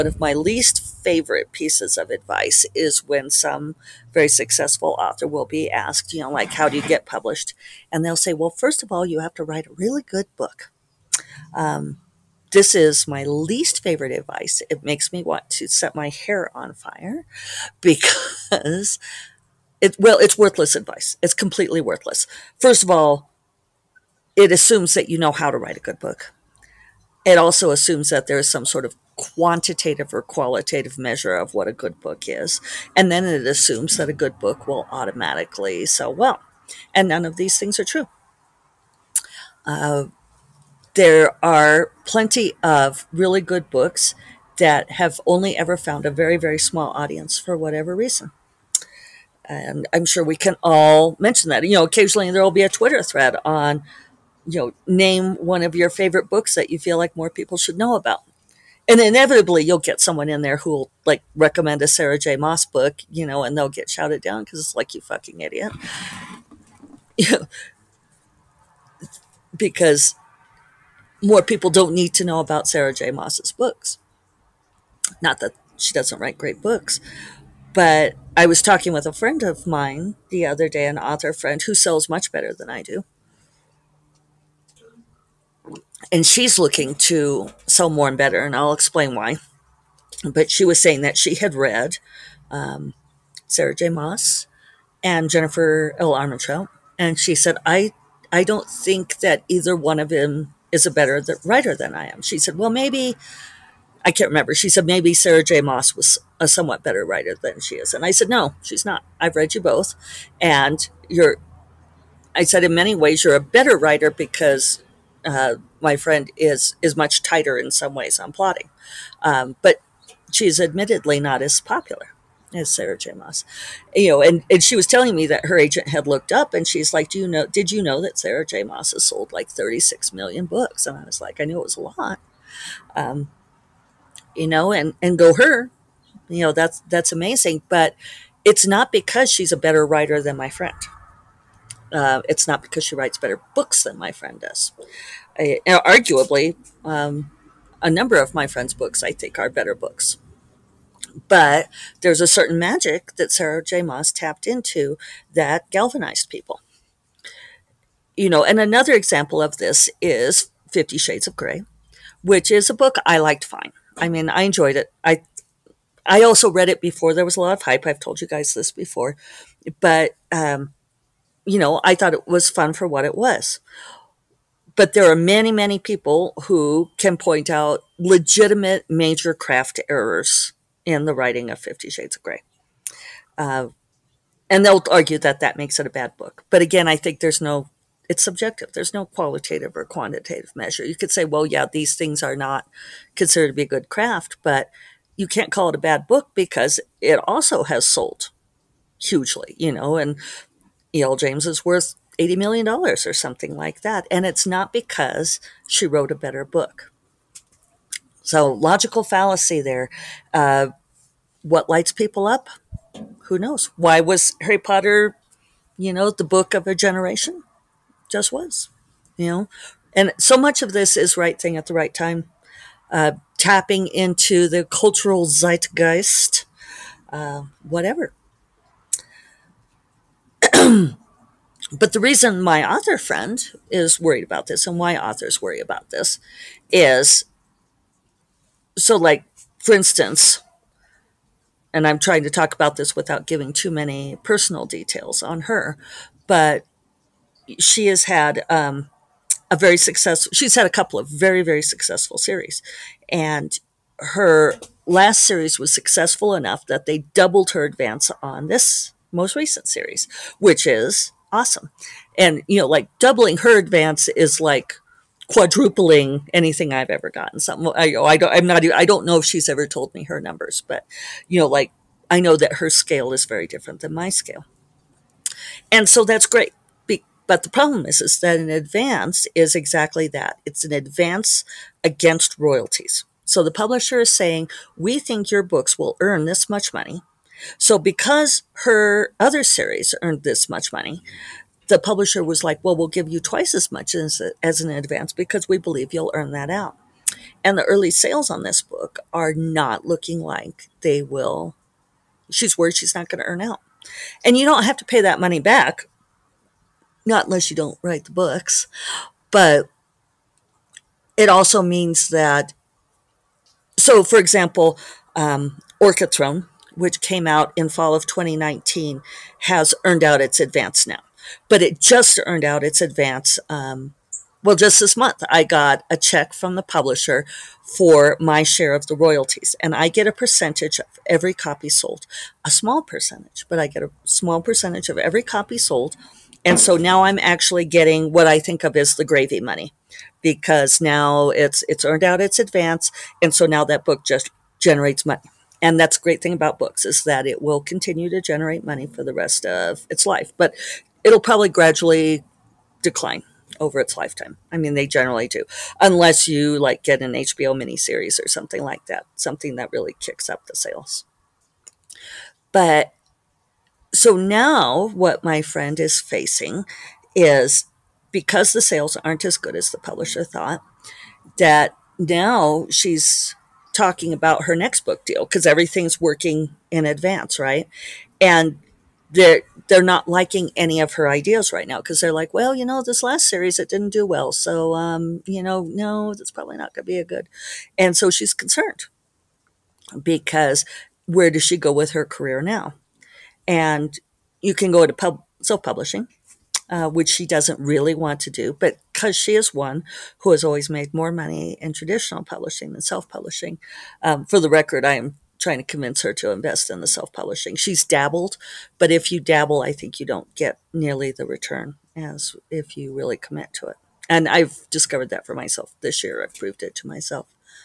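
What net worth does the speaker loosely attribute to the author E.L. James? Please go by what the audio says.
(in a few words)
80 million dollars.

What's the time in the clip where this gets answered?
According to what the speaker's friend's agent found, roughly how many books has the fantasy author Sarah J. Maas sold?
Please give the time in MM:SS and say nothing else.
02:09.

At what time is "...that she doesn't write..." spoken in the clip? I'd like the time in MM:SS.
01:15.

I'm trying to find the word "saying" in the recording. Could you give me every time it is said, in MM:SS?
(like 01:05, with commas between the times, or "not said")
01:30, 04:44.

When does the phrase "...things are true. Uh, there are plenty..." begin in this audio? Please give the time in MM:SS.
00:37.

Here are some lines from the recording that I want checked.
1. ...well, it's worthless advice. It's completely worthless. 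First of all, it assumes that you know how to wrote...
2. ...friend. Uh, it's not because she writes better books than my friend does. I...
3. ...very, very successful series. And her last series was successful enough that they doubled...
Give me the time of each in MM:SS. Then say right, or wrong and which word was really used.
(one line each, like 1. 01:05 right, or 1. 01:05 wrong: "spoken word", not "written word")
1. 00:19 wrong: "write", not "wrote"
2. 02:20 right
3. 04:11 right.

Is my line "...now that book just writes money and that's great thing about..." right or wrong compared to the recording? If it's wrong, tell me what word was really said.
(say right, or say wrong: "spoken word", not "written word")
wrong: "generates", not "writes".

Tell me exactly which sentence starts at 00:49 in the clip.
And I'm sure we can all mention that.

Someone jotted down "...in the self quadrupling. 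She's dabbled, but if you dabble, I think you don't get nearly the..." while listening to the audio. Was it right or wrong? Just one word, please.
wrong.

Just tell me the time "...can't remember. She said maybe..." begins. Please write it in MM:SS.
01:44.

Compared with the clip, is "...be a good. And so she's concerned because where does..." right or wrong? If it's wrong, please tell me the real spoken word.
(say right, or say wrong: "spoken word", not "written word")
right.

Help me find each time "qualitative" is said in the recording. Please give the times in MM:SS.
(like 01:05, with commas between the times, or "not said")
00:30, 03:09.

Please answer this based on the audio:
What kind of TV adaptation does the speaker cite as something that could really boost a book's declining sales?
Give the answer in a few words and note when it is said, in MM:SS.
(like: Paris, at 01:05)
HBO miniseries, at 05:57.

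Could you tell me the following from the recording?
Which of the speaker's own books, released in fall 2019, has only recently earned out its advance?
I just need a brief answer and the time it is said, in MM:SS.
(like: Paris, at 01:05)
Orchid Throne, at 05:15.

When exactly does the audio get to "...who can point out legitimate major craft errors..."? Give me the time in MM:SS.
02:56.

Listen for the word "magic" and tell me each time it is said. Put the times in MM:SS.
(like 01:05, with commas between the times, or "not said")
02:32.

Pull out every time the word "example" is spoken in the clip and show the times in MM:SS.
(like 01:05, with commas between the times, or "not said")
02:38, 05:14.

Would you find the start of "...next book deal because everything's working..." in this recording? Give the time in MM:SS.
06:14.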